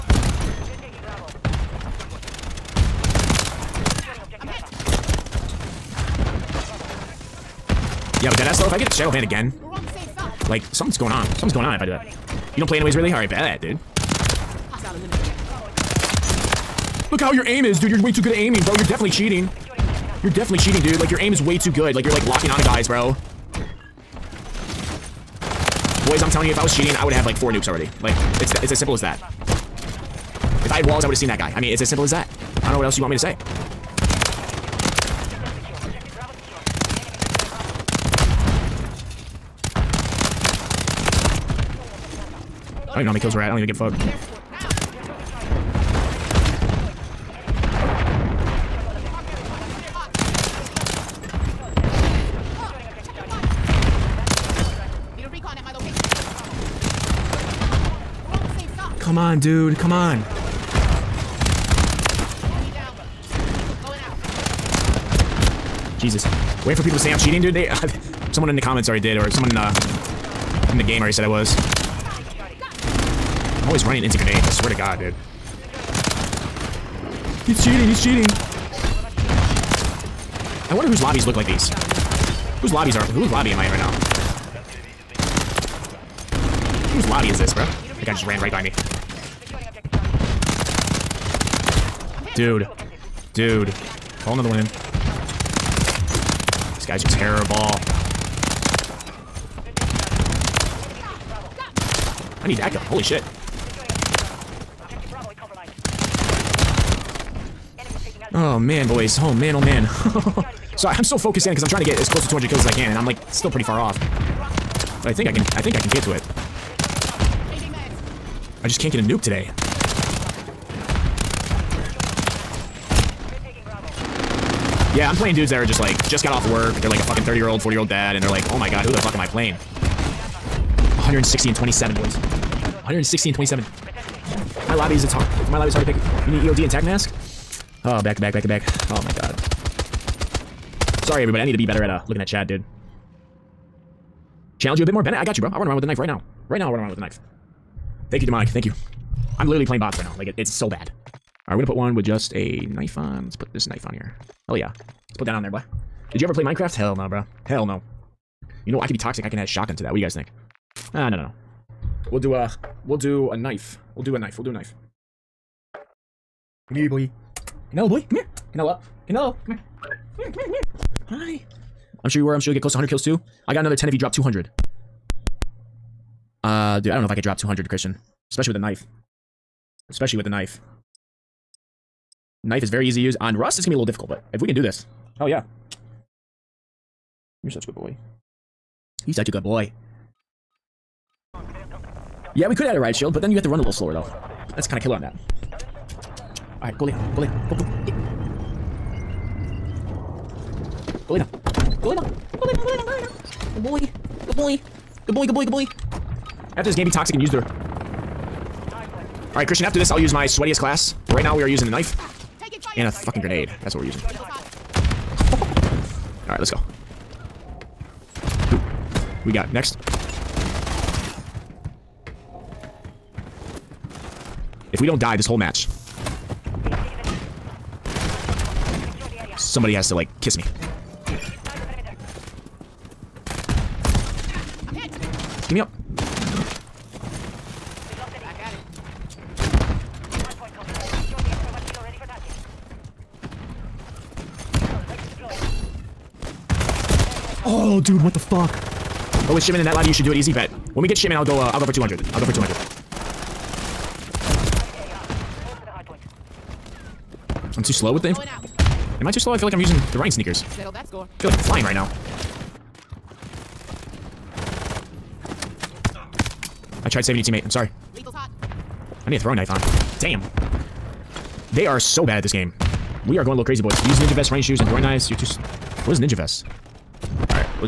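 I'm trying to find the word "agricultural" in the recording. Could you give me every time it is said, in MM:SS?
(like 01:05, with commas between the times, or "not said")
not said.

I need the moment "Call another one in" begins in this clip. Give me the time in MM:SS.
01:34.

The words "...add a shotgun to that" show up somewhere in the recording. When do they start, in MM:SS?
02:39.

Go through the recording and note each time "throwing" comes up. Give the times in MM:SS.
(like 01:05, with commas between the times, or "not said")
04:29, 04:34.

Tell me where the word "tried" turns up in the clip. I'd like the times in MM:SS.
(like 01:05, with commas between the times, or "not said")
04:26.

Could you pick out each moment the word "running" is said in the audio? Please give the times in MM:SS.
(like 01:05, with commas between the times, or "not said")
01:13, 04:34.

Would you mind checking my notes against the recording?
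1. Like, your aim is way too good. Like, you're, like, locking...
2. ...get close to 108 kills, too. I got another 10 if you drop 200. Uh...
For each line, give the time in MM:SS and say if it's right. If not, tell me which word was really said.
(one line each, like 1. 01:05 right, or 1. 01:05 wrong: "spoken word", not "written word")
1. 00:20 right
2. 02:52 wrong: "100", not "108".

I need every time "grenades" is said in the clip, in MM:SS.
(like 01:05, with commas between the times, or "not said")
01:14, 03:33.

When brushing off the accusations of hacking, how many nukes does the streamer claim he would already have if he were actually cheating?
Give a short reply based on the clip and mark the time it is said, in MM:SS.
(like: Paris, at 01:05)
4, at 00:27.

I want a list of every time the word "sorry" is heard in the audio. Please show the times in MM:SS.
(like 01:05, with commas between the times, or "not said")
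02:21, 04:27.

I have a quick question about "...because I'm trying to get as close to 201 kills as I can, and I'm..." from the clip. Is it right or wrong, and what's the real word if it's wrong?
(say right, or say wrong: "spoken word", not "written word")
wrong: "200", not "201".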